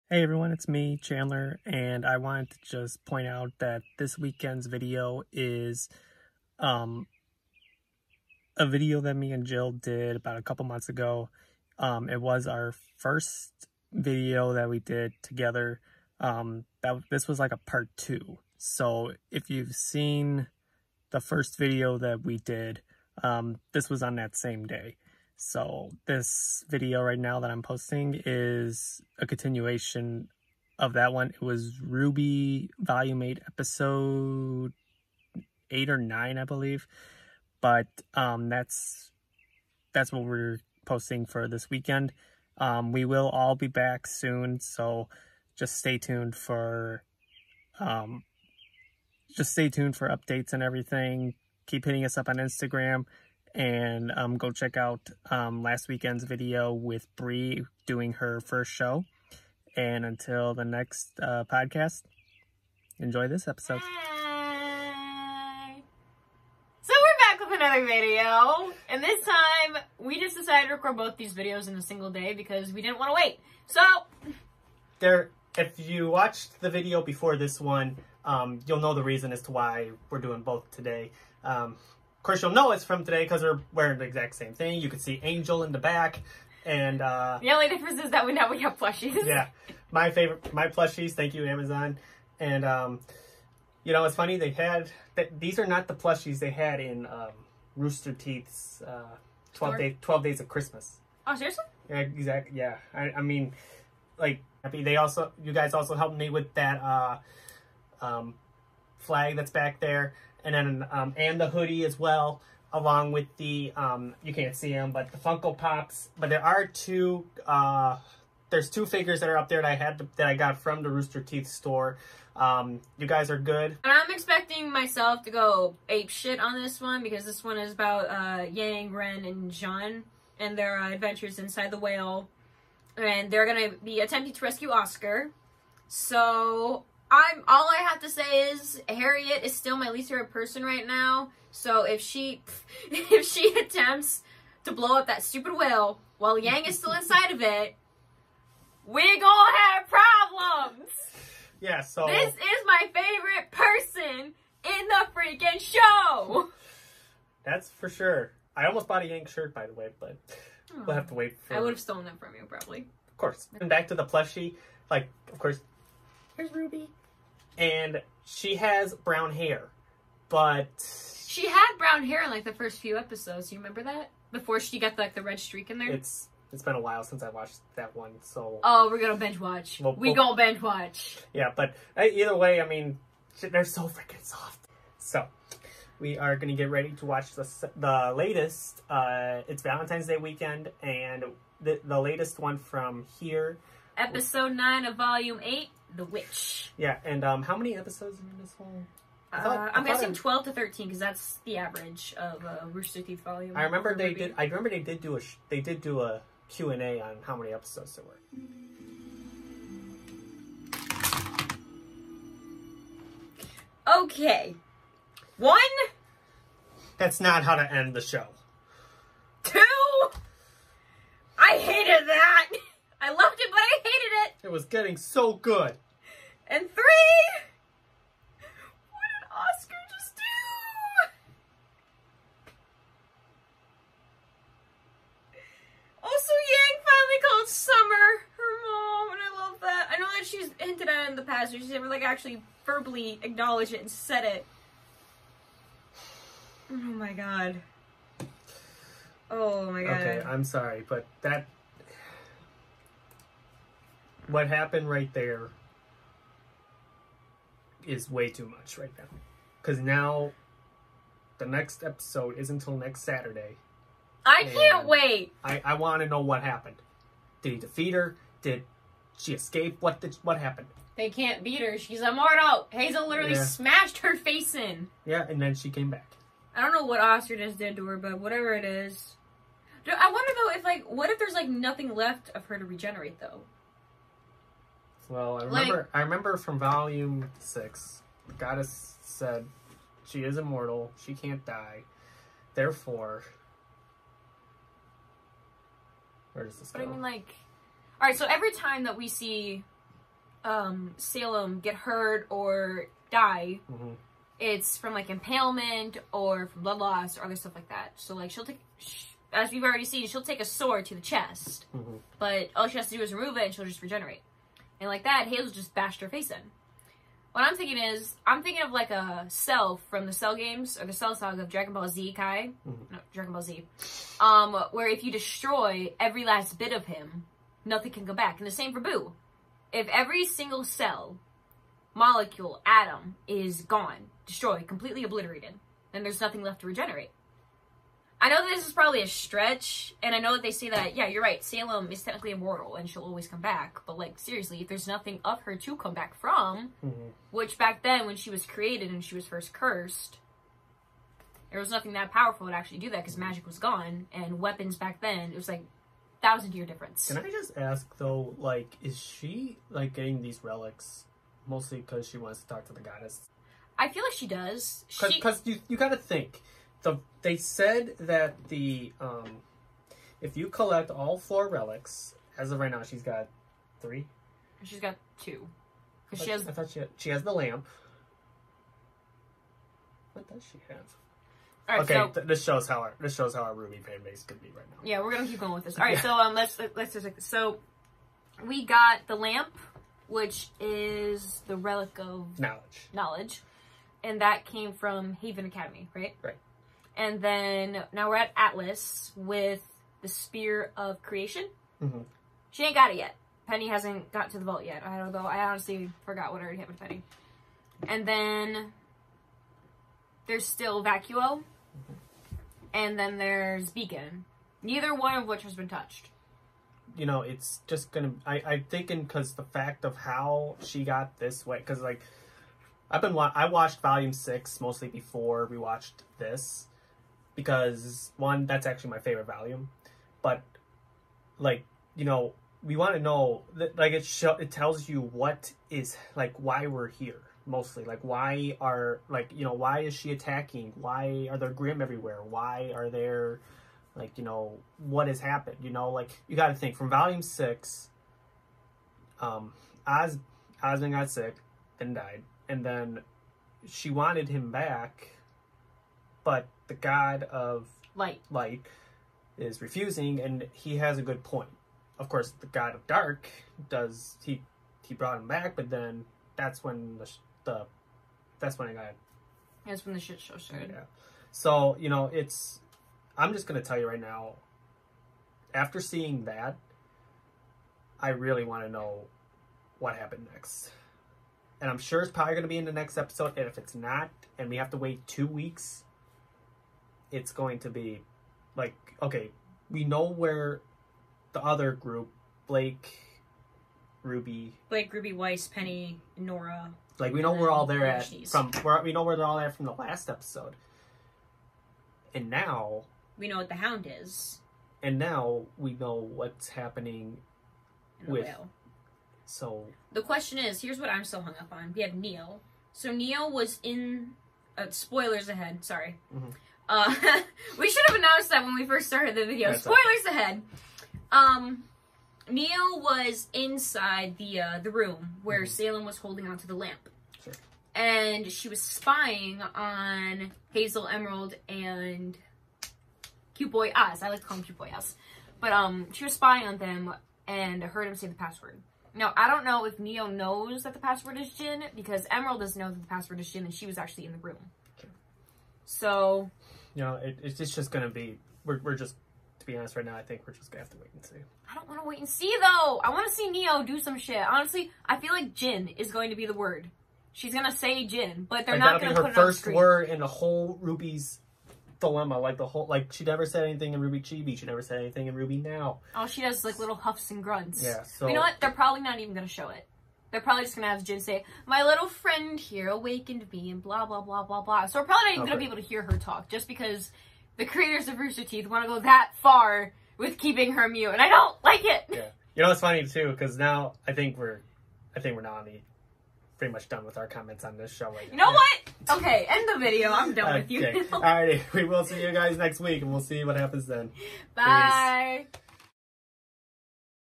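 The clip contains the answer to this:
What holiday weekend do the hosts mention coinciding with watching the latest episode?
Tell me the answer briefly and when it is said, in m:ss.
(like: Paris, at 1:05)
Valentine's Day, at 3:09.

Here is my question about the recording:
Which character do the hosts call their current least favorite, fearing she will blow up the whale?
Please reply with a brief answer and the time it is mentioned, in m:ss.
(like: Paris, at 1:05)
Harriet, at 2:18.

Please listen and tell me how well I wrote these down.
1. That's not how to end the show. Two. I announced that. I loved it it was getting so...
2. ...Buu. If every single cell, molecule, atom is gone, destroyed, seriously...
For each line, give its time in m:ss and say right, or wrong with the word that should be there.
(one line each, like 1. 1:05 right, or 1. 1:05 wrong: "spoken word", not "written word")
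1. 3:36 wrong: "hated", not "announced"
2. 5:28 wrong: "completely", not "seriously".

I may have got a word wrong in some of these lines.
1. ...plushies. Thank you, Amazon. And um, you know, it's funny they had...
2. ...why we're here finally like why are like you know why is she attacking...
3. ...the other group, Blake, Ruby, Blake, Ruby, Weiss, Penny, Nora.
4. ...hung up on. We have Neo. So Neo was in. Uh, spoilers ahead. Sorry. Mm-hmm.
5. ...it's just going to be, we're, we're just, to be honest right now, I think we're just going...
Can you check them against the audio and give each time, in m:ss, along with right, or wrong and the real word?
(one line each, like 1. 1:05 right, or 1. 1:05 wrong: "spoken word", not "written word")
1. 1:30 right
2. 7:16 wrong: "mostly", not "finally"
3. 8:11 right
4. 8:31 right
5. 9:07 right.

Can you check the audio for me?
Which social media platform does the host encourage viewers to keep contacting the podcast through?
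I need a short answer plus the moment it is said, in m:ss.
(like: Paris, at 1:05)
Instagram, at 0:52.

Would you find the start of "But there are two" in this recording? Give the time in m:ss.
1:56.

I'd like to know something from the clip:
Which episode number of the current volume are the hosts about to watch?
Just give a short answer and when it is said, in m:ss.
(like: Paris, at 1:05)
9, at 3:13.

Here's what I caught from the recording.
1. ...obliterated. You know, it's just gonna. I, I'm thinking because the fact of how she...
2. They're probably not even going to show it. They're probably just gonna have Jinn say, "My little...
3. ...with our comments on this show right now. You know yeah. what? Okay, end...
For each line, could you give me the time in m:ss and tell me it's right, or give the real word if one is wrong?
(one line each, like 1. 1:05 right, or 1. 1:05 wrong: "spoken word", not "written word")
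1. 6:55 wrong: "touched", not "obliterated"
2. 9:28 right
3. 9:46 right.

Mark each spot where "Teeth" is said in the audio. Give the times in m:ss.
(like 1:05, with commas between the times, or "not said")
1:38, 2:01, 3:23, 9:38.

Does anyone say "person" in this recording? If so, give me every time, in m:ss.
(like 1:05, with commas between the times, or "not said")
2:20, 2:33.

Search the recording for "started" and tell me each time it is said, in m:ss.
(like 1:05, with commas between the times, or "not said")
7:50, 8:38.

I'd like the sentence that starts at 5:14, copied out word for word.
And like that, Halo just bashed her face in.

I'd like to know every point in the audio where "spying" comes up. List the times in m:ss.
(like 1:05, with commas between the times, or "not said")
8:48, 8:56.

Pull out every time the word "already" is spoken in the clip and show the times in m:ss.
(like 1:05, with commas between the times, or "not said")
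5:09, 6:46.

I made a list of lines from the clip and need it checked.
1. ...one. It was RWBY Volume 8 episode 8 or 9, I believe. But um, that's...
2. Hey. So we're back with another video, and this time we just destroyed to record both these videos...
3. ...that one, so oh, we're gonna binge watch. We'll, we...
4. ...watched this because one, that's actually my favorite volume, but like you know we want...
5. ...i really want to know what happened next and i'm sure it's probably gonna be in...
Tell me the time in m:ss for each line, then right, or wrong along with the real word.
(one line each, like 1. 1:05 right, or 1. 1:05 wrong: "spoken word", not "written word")
1. 0:31 right
2. 1:03 wrong: "decided", not "destroyed"
3. 2:57 right
4. 7:05 right
5. 7:57 right.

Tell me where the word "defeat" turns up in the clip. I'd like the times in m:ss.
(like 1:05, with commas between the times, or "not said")
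4:27.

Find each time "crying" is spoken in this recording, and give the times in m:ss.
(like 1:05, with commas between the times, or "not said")
not said.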